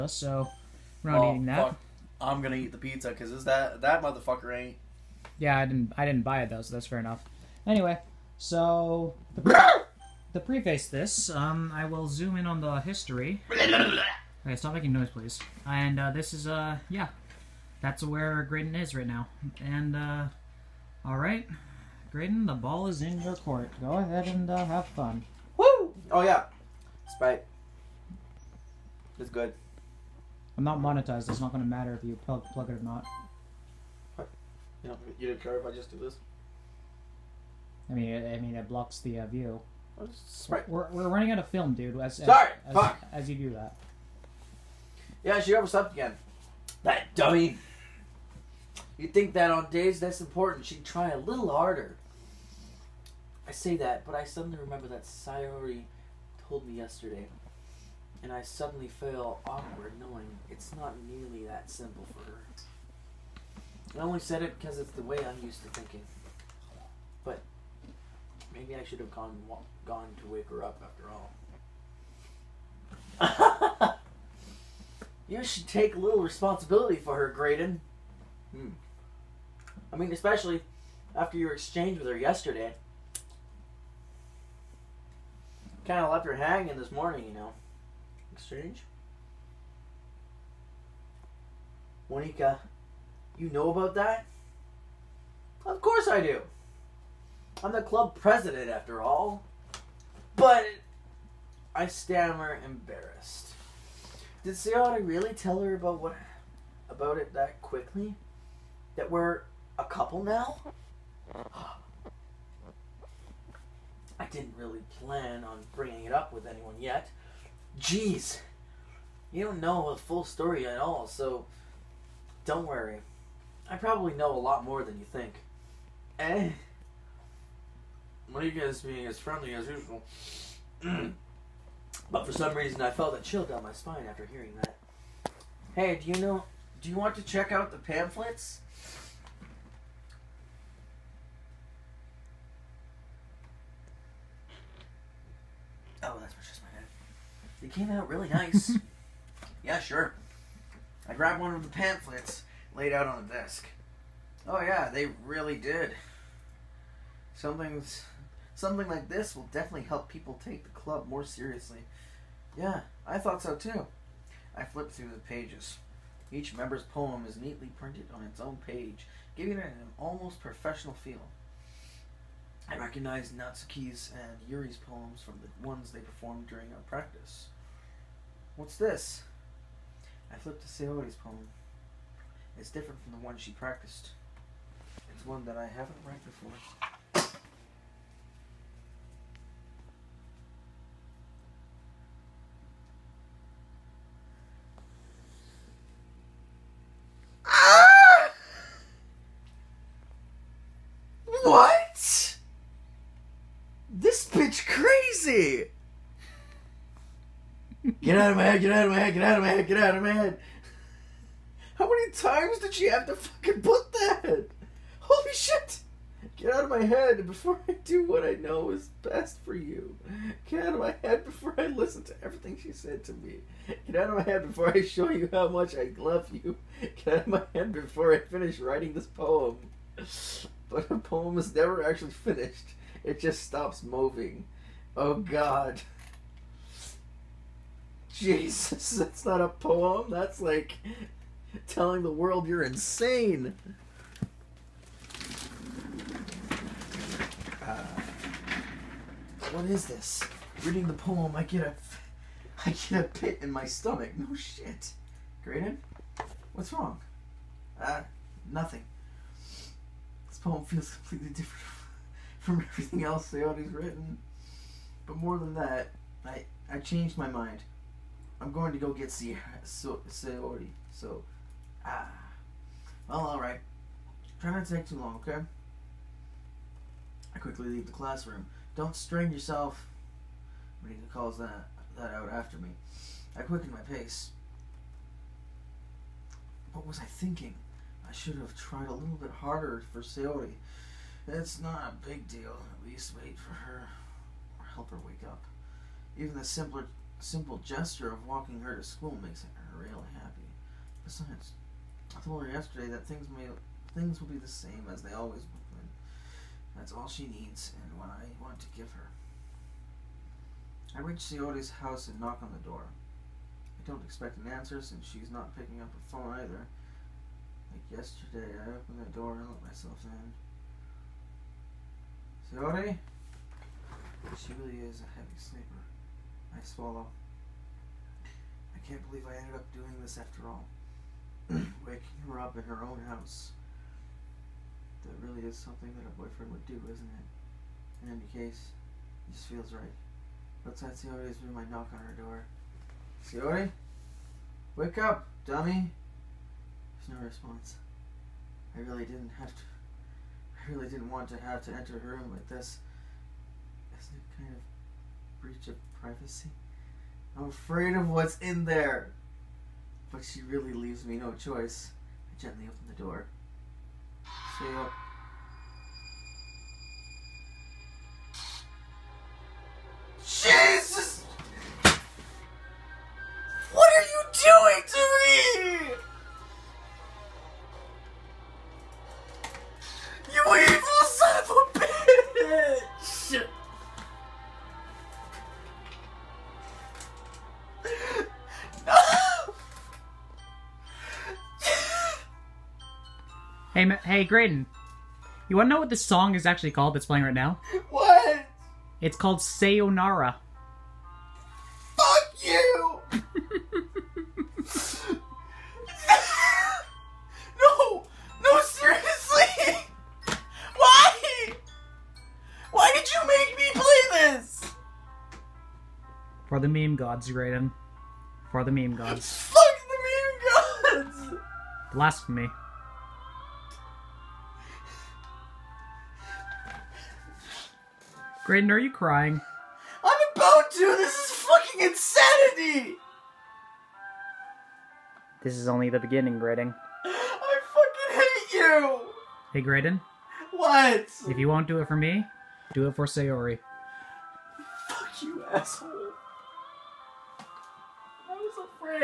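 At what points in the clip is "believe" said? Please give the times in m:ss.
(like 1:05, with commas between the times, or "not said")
5:29.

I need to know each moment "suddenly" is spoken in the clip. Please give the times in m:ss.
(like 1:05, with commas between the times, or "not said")
0:54, 0:58.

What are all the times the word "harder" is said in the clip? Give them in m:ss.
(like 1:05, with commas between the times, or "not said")
0:51, 4:49.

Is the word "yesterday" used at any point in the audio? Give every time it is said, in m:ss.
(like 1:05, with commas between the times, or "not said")
0:56, 1:22, 5:02, 5:17.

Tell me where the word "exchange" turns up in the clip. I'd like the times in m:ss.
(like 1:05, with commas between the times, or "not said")
1:21, 1:28.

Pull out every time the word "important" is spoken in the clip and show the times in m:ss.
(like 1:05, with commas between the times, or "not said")
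0:50.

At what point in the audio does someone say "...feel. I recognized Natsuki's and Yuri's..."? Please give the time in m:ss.
2:50.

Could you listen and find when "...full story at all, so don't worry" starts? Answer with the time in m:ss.
2:00.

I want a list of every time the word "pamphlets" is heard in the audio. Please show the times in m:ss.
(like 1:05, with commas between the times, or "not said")
2:17, 2:31.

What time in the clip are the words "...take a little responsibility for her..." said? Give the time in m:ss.
1:15.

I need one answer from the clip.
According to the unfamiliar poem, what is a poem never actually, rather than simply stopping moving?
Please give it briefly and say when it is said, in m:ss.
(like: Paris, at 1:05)
Finished, at 3:51.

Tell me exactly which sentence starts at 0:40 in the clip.
We're, we're, running out of film, dude.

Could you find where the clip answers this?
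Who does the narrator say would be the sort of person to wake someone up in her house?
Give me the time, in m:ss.
5:36.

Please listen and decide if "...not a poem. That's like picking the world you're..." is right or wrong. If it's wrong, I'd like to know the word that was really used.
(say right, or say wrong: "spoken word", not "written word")
wrong: "telling", not "picking".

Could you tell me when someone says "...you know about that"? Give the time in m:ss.
1:33.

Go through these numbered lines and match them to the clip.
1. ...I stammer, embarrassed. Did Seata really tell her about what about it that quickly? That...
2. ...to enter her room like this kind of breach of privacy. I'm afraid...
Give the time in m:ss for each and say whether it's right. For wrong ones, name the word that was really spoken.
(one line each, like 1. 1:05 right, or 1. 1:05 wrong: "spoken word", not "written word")
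1. 1:41 right
2. 5:51 right.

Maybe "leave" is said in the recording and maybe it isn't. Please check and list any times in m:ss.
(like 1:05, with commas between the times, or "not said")
4:37, 6:00.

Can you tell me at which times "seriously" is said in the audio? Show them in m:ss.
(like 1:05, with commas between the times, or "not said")
2:41, 6:48.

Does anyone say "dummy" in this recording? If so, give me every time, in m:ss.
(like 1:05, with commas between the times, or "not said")
0:47, 5:45.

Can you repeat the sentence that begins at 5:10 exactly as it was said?
I reach Siote's house and knock on the door.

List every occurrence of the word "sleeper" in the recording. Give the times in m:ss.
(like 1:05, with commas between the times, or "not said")
5:25.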